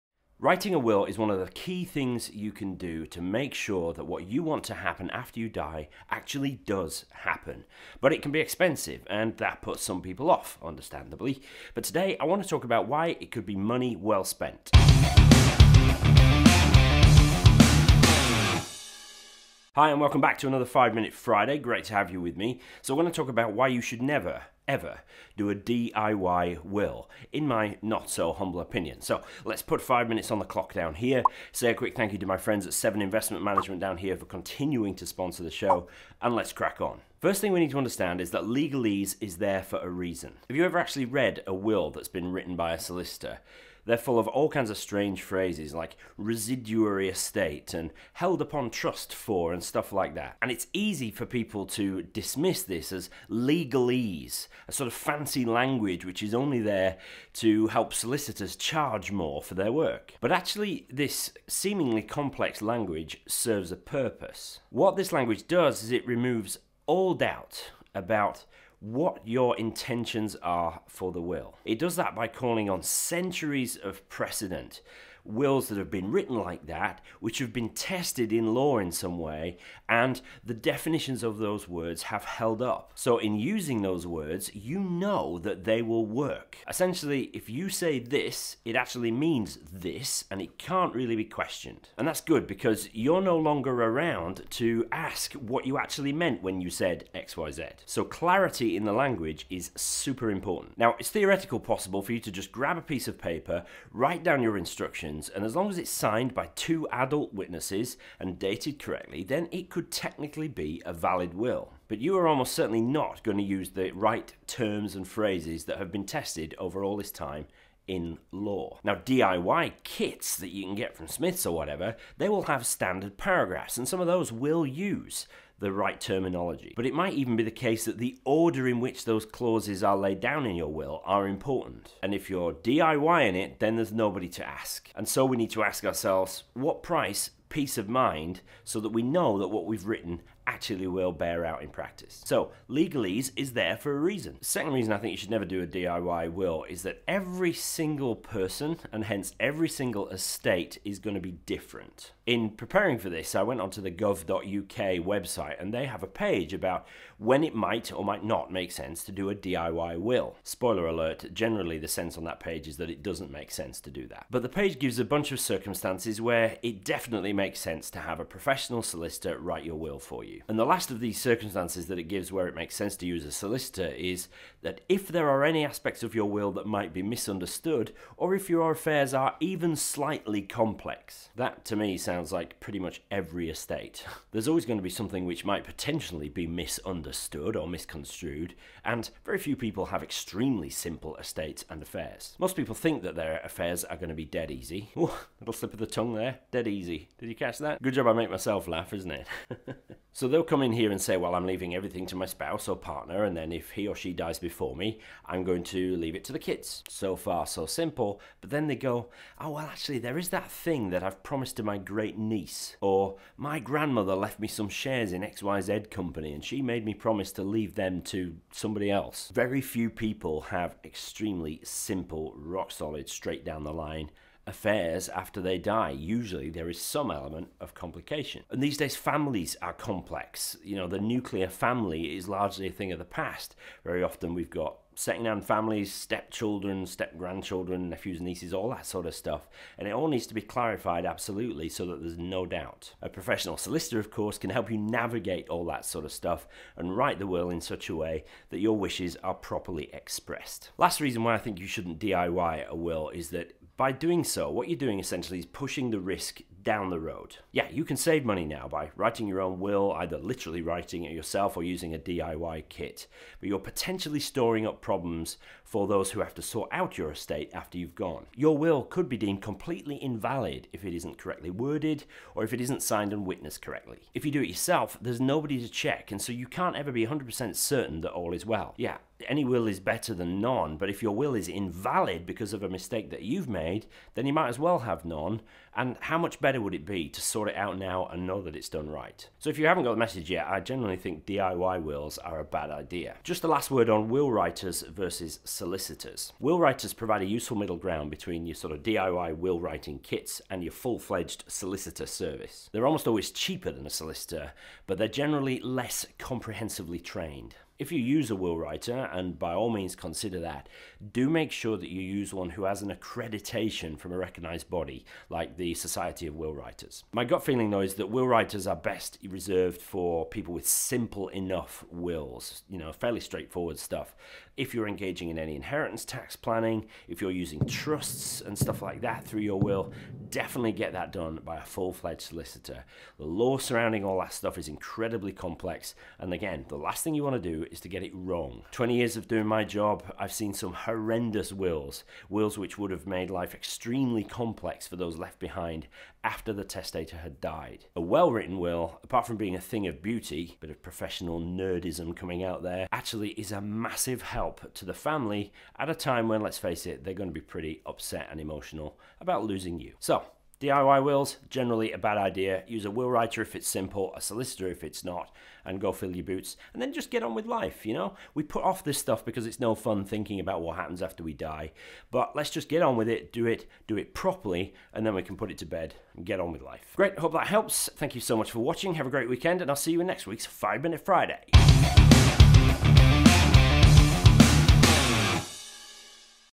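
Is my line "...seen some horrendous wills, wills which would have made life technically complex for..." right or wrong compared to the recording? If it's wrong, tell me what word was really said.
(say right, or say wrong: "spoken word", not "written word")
wrong: "extremely", not "technically".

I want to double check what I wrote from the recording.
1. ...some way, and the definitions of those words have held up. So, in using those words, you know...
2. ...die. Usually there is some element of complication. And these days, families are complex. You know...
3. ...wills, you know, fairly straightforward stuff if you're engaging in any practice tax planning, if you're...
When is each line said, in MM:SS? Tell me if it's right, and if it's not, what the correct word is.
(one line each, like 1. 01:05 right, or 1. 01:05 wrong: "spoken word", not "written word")
1. 01:18 right
2. 03:45 right
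3. 05:21 wrong: "inheritance", not "practice".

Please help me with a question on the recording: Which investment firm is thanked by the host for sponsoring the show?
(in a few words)
7 Investment Management.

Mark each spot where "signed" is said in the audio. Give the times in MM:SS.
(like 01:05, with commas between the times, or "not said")
01:45, 04:32.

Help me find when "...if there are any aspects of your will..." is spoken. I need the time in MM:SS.
02:54.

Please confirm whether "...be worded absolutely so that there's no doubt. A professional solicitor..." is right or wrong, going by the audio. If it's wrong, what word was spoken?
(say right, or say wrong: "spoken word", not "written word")
wrong: "clarified", not "worded".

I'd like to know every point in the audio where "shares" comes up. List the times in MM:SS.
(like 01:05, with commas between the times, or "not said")
03:34.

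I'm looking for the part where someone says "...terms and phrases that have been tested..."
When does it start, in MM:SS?
01:54.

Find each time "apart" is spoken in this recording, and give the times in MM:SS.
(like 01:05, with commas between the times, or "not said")
05:49.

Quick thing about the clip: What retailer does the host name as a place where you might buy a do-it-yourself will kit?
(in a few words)
Smiths.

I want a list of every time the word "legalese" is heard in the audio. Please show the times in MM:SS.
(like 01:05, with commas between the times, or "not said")
00:38, 00:53, 02:22.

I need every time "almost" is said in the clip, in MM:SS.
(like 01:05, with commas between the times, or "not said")
01:52, 05:02.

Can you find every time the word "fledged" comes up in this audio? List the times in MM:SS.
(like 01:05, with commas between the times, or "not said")
05:00, 05:31.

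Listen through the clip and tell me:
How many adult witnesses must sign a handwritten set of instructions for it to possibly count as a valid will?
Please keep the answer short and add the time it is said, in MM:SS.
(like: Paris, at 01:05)
2, at 01:46.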